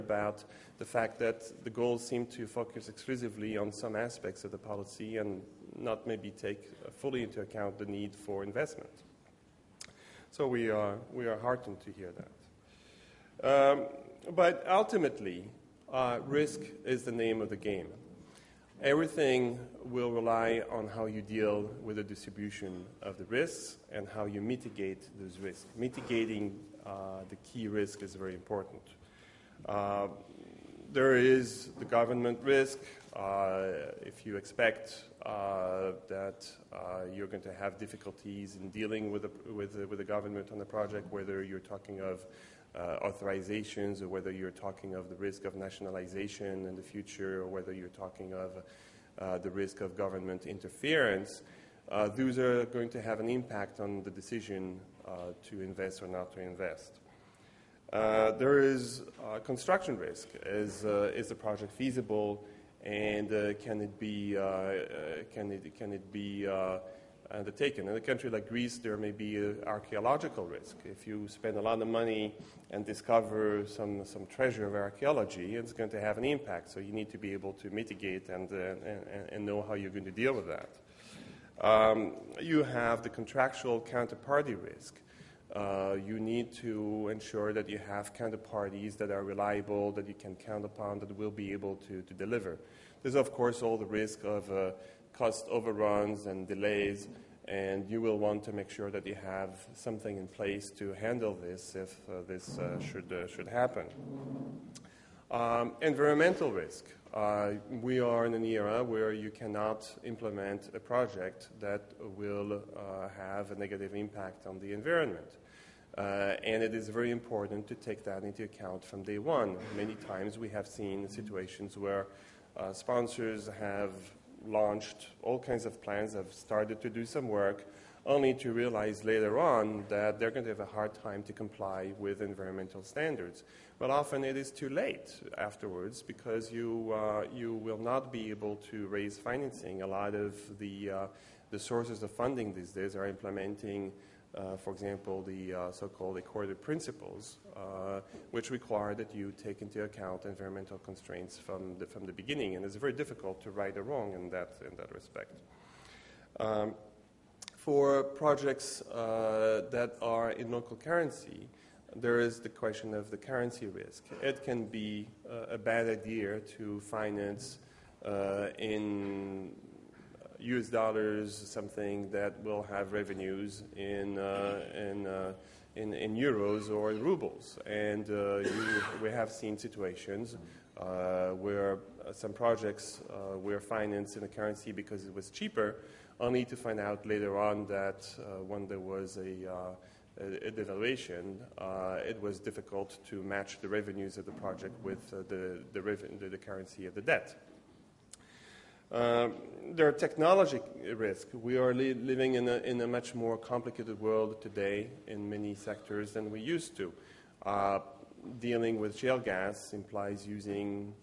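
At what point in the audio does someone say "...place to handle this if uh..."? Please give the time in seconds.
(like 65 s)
100 s.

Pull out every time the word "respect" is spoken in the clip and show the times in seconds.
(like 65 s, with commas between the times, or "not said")
154 s.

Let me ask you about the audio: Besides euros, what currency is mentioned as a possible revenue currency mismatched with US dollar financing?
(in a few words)
rubles.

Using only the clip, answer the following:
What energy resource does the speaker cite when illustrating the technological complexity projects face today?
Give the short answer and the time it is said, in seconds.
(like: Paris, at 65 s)
shale gas, at 208 s.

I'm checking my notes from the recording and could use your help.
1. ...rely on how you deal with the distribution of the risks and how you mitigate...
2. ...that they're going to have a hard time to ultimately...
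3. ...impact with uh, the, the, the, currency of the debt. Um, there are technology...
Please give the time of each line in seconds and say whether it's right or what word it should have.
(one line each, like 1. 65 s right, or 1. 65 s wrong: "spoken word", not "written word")
1. 20 s right
2. 129 s wrong: "comply", not "ultimately"
3. 194 s wrong: "project", not "impact".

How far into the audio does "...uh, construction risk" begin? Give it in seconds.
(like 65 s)
59 s.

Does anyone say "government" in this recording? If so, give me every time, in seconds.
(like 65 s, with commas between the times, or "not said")
31 s, 40 s, 49 s.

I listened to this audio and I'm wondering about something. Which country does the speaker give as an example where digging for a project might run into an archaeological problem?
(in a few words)
Greece.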